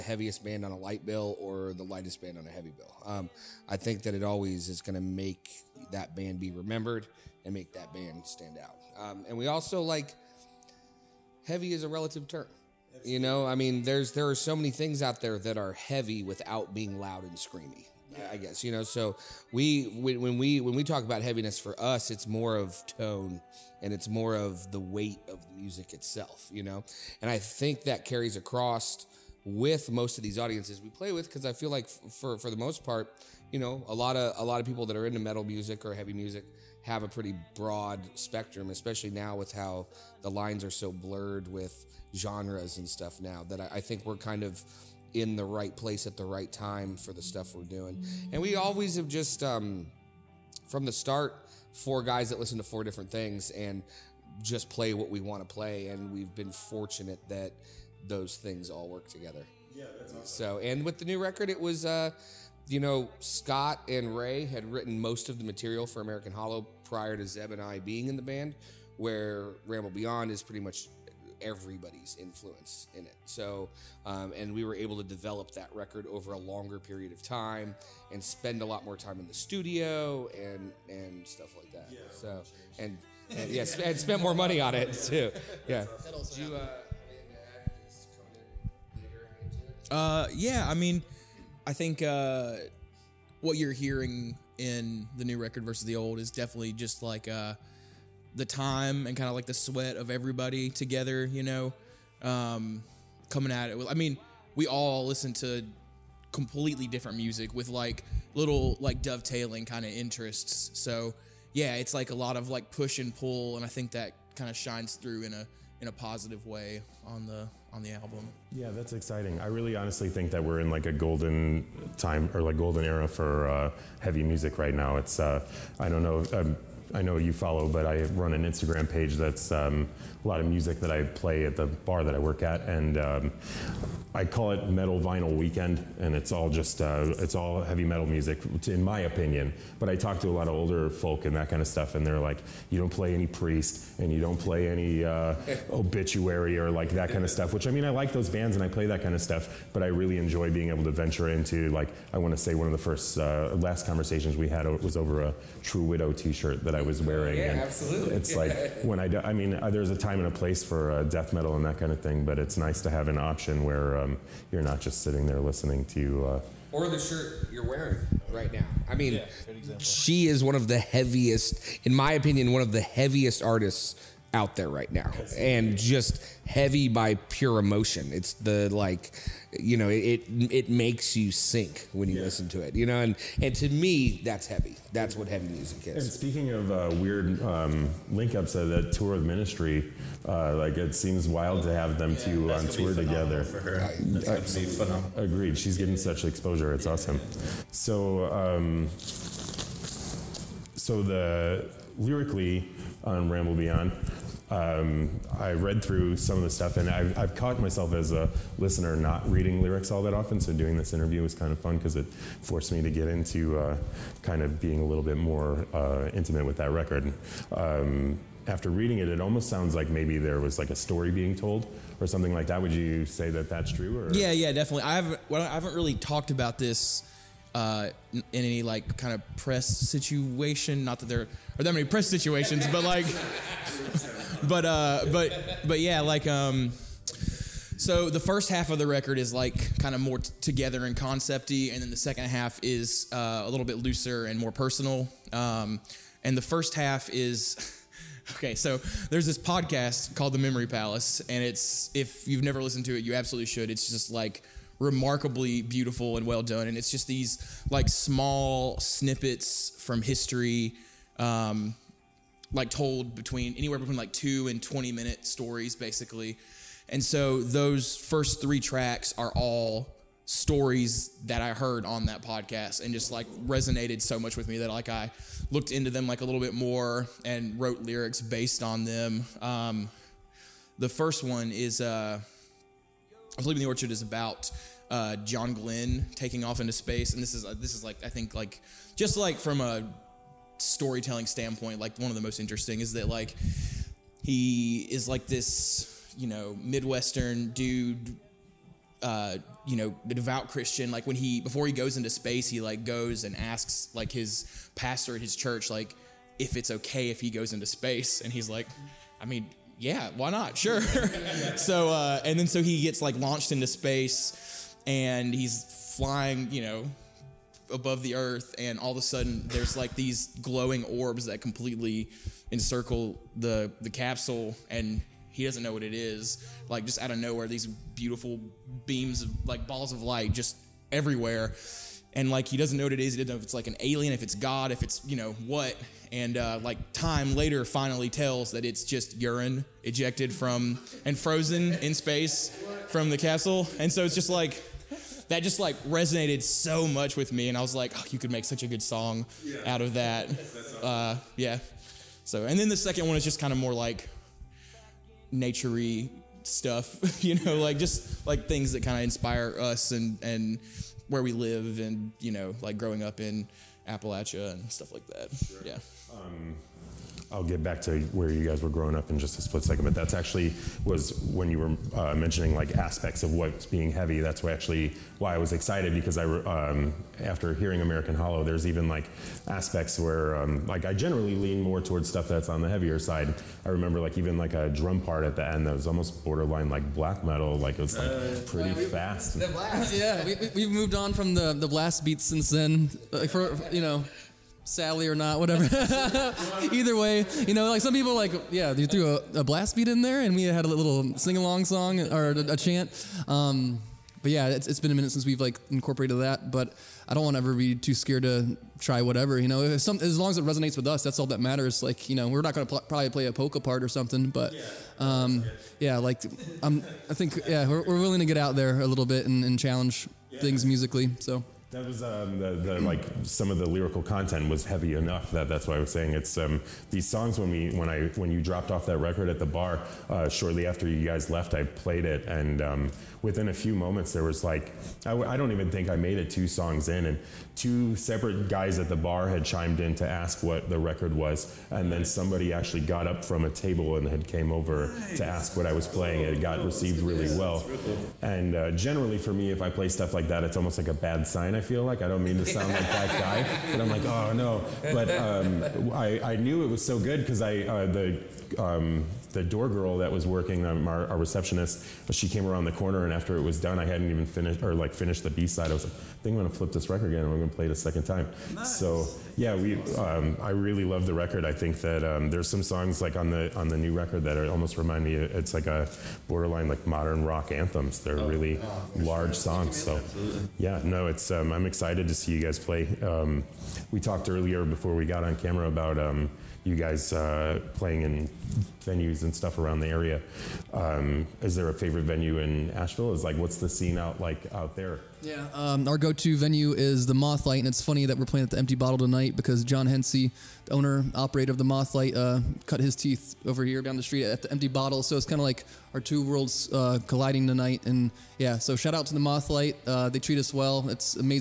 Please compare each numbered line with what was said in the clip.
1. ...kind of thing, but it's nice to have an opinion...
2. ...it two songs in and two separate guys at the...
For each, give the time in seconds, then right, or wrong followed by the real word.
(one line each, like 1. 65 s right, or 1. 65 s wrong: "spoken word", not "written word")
1. 161 s wrong: "option", not "opinion"
2. 436 s right.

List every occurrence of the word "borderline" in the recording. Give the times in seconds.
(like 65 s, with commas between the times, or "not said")
386 s, 476 s.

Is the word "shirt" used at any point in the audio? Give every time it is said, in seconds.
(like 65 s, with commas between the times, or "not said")
156 s, 166 s.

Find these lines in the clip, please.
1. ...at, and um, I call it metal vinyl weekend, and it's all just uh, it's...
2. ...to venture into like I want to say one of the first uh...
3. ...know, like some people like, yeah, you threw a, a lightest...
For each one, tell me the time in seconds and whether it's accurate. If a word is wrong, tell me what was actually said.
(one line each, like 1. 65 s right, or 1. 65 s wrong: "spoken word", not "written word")
1. 132 s right
2. 150 s right
3. 397 s wrong: "blast", not "lightest".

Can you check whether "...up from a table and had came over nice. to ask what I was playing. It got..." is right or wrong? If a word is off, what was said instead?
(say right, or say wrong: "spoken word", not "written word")
right.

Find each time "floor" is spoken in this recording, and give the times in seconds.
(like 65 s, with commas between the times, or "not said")
not said.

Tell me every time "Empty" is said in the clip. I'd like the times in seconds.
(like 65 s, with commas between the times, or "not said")
498 s, 504 s.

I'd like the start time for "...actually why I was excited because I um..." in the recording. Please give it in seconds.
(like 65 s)
374 s.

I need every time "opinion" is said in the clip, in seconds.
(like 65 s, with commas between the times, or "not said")
139 s, 172 s.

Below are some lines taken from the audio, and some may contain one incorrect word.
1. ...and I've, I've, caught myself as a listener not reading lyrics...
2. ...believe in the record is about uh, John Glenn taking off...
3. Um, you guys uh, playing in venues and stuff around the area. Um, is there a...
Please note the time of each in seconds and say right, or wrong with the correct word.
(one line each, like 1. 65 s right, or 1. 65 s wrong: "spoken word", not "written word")
1. 206 s right
2. 283 s wrong: "orchard", not "record"
3. 485 s right.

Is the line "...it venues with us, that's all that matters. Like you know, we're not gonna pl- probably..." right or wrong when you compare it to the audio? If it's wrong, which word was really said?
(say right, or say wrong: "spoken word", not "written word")
wrong: "resonates", not "venues".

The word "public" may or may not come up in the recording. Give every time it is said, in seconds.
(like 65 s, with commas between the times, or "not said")
not said.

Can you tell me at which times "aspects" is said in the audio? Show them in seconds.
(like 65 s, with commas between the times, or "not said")
372 s, 379 s.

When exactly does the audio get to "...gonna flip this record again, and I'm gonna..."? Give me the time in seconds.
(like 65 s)
466 s.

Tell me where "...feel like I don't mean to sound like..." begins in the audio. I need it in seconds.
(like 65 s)
451 s.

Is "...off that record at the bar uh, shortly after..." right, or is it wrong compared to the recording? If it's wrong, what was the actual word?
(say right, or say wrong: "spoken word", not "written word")
right.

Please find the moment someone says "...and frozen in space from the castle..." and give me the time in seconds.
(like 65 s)
341 s.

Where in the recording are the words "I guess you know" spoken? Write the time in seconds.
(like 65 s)
18 s.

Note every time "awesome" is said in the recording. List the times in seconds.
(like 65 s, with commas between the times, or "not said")
60 s, 196 s, 350 s.